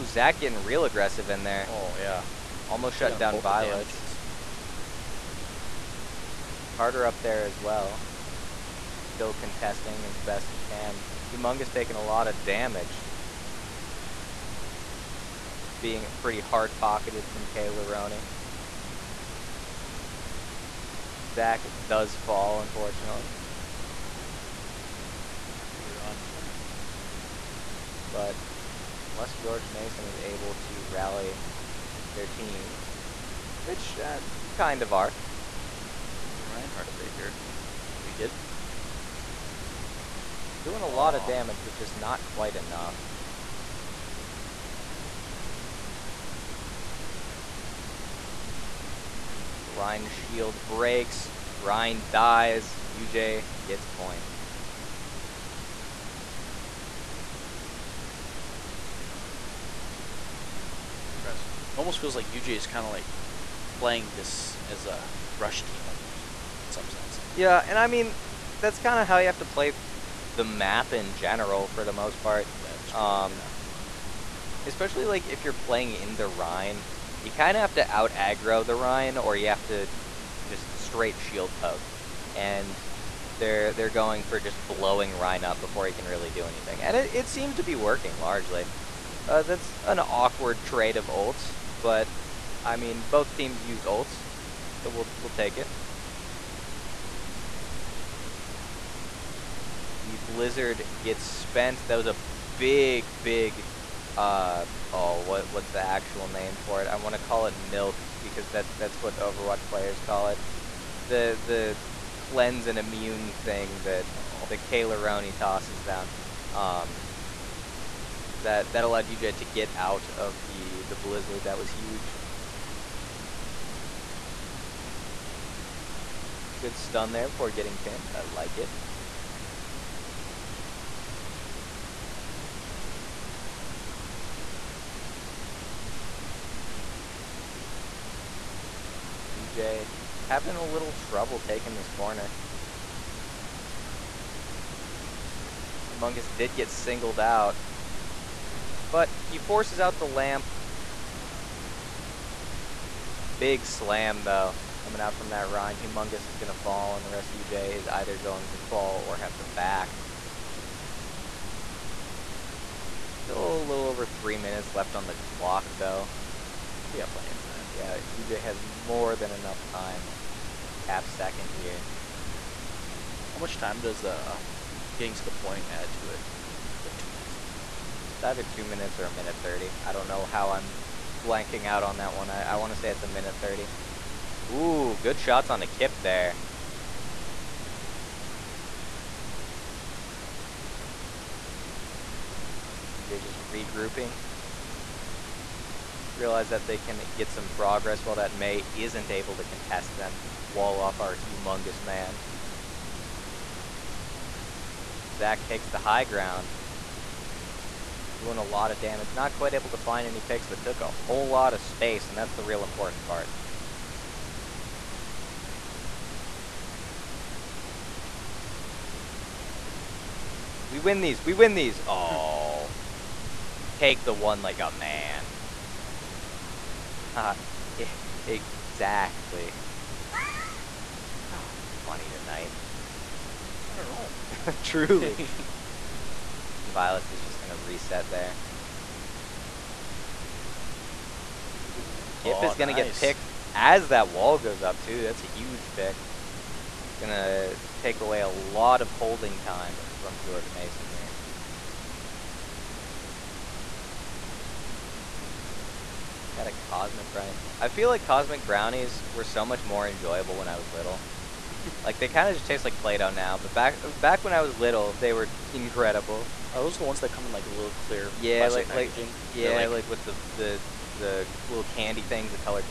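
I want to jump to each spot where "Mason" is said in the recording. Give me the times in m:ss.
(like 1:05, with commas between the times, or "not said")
0:29, 4:10.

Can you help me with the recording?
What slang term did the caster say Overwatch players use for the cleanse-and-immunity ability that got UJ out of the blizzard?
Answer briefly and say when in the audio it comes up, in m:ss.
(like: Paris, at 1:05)
milk, at 1:47.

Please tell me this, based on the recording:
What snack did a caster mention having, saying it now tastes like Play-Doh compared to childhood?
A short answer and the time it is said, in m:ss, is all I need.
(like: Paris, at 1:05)
Cosmic Brownie, at 4:16.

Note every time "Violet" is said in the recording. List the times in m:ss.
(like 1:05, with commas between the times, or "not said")
0:03, 3:56.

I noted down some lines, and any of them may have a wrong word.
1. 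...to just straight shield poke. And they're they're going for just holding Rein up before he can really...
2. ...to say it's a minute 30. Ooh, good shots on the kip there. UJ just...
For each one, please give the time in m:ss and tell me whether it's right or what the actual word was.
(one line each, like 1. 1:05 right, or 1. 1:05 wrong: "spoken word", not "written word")
1. 1:19 wrong: "blowing", not "holding"
2. 3:02 right.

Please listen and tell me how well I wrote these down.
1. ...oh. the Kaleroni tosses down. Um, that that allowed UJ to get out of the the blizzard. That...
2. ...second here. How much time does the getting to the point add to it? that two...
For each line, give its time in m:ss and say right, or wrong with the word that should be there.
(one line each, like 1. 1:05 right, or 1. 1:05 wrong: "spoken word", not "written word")
1. 1:54 right
2. 2:51 right.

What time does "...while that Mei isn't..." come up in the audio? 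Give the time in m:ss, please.
3:18.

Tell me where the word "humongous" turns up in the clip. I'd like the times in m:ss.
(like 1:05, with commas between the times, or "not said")
0:11, 2:25, 2:35, 3:21.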